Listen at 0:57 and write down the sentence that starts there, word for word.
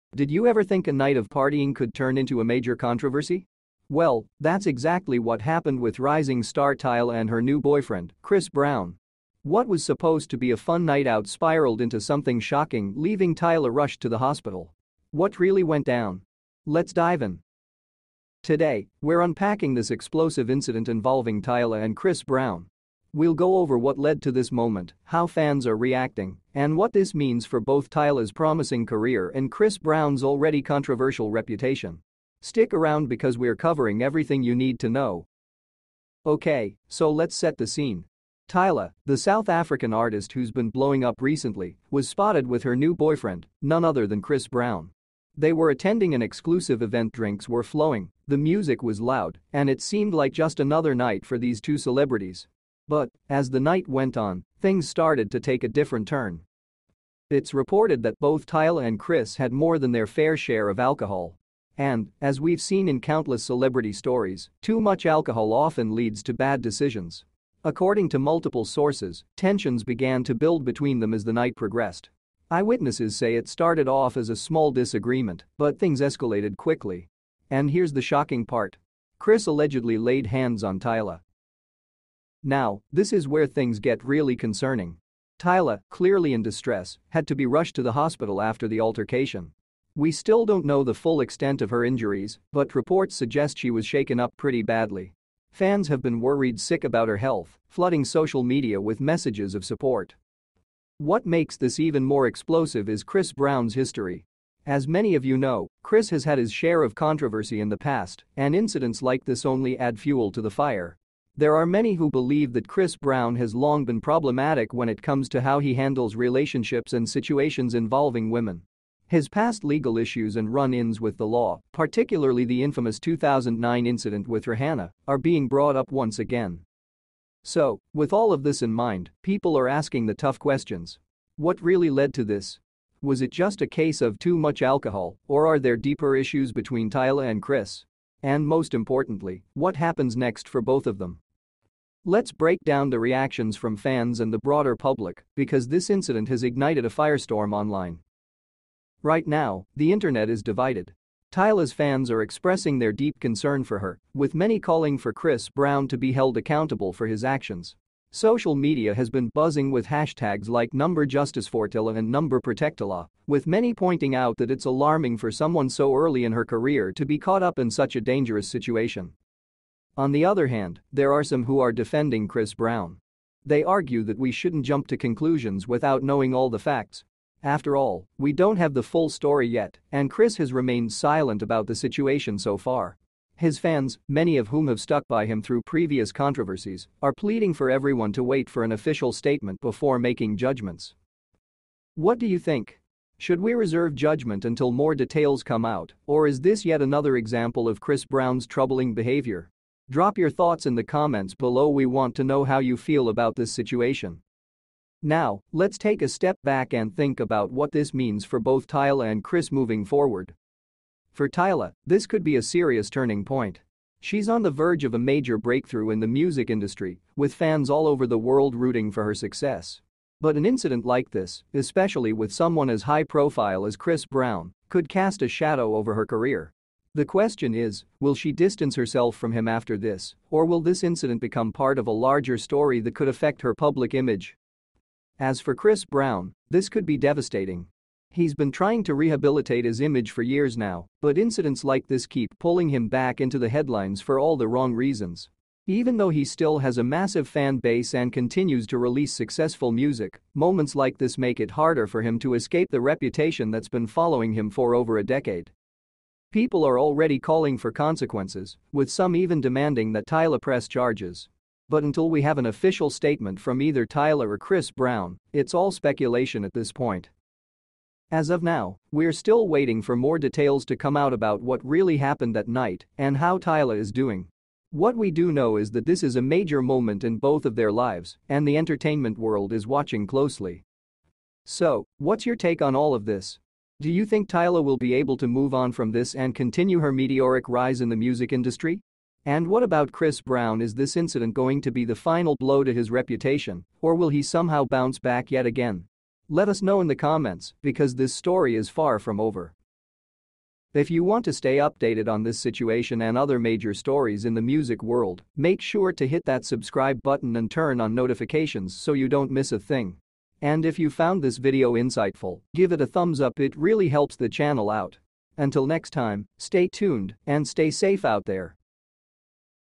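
It's reported that both Tyla and Chris had more than their fair share of alcohol.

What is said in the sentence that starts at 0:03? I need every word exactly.
Well, that's exactly what happened with rising star Tyla and her new boyfriend, Chris Brown.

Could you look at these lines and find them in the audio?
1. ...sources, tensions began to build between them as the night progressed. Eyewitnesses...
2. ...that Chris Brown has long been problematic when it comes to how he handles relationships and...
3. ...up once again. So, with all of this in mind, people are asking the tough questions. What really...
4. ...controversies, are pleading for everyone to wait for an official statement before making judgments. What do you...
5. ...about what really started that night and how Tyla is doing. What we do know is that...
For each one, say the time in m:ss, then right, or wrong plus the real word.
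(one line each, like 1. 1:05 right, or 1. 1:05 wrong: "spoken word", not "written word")
1. 1:08 right
2. 1:52 right
3. 2:05 right
4. 3:06 right
5. 4:31 wrong: "happened", not "started".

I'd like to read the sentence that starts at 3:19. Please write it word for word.
Drop your thoughts in the comments below we want to know how you feel about this situation.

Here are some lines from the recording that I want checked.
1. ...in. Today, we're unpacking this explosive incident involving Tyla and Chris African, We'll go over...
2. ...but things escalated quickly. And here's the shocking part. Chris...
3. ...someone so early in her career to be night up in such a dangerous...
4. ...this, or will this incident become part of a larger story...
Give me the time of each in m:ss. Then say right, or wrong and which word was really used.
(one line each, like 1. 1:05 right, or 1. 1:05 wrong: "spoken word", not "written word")
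1. 0:17 wrong: "Brown", not "African"
2. 1:15 right
3. 2:45 wrong: "caught", not "night"
4. 3:49 right.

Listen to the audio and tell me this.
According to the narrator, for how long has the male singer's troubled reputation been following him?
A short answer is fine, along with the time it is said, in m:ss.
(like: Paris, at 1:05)
over a decade, at 4:14.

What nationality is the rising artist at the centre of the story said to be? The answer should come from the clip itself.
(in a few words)
South African.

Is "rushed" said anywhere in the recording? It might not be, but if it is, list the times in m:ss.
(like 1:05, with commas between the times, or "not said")
0:13, 1:27.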